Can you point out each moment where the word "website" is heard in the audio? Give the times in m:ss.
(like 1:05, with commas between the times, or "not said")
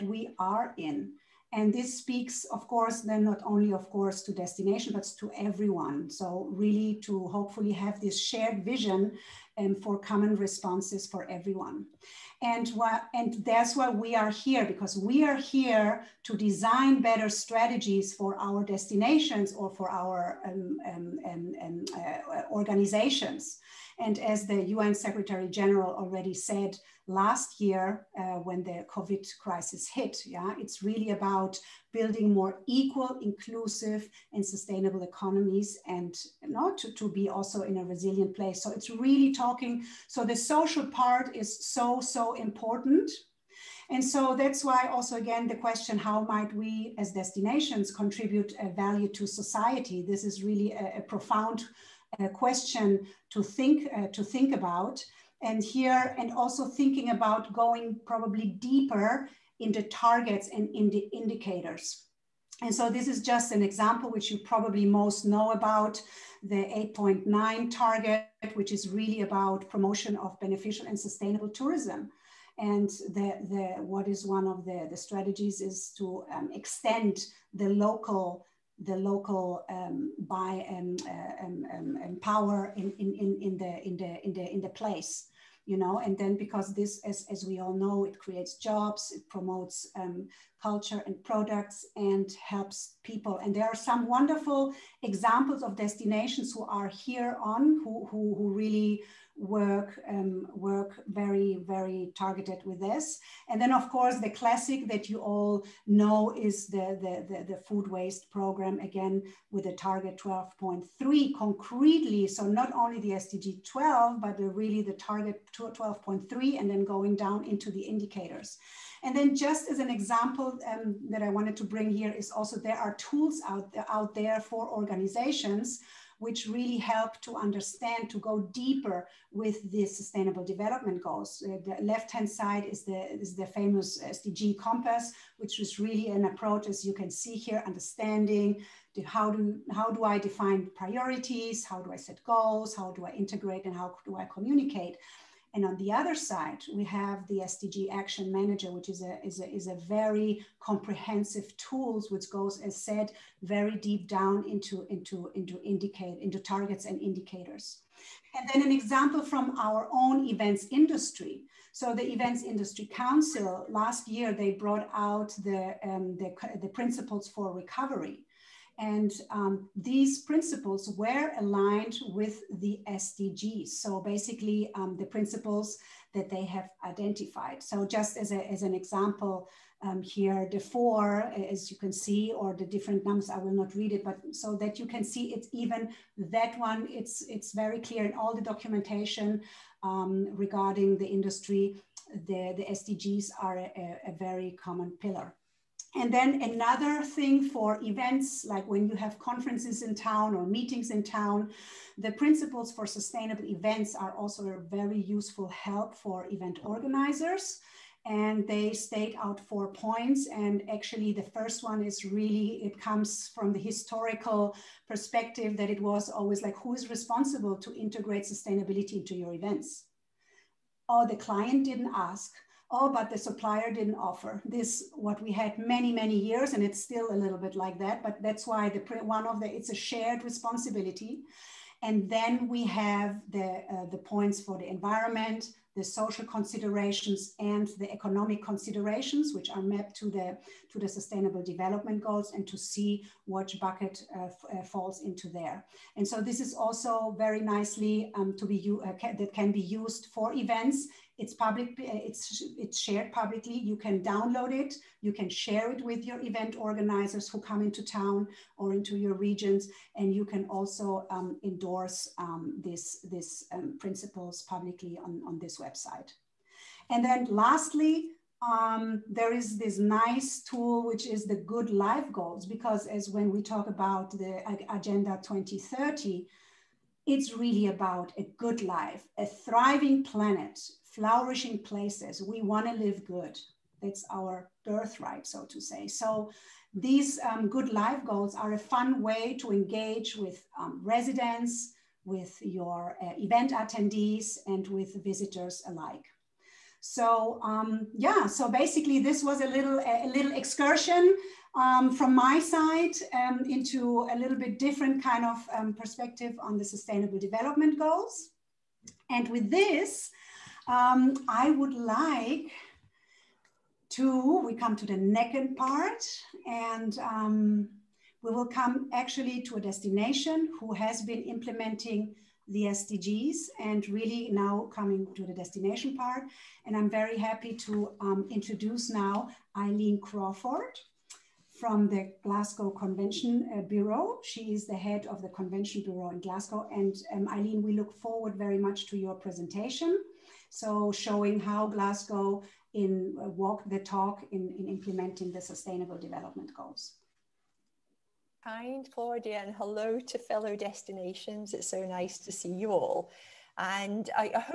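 4:25.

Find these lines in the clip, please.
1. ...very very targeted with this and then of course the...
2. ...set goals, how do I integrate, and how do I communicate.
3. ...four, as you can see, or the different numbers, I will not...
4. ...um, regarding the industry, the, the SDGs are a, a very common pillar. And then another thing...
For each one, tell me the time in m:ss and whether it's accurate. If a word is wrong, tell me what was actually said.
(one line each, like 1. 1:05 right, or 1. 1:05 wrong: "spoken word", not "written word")
1. 1:41 right
2. 2:21 right
3. 3:00 right
4. 3:09 right.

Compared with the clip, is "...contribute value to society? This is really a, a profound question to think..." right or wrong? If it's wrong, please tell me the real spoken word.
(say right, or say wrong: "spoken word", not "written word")
right.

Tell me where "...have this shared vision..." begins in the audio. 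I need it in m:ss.
0:07.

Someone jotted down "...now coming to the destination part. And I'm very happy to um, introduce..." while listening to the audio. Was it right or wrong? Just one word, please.
right.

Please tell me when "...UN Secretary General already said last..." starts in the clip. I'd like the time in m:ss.
0:24.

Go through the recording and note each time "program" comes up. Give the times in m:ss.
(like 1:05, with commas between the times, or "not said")
1:48.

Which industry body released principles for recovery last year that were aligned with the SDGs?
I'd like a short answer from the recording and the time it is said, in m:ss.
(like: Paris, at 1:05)
Events Industry Council, at 2:42.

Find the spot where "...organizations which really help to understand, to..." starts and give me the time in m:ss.
2:04.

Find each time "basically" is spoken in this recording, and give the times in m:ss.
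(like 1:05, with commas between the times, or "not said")
2:54, 4:58.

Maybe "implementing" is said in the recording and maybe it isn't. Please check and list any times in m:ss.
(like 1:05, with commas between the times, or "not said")
5:21, 5:44.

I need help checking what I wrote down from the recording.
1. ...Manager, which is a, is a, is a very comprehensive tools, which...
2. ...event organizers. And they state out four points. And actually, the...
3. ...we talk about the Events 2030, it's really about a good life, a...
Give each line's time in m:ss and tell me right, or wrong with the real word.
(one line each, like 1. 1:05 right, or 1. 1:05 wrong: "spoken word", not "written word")
1. 2:28 right
2. 3:26 right
3. 4:33 wrong: "Agenda", not "Events".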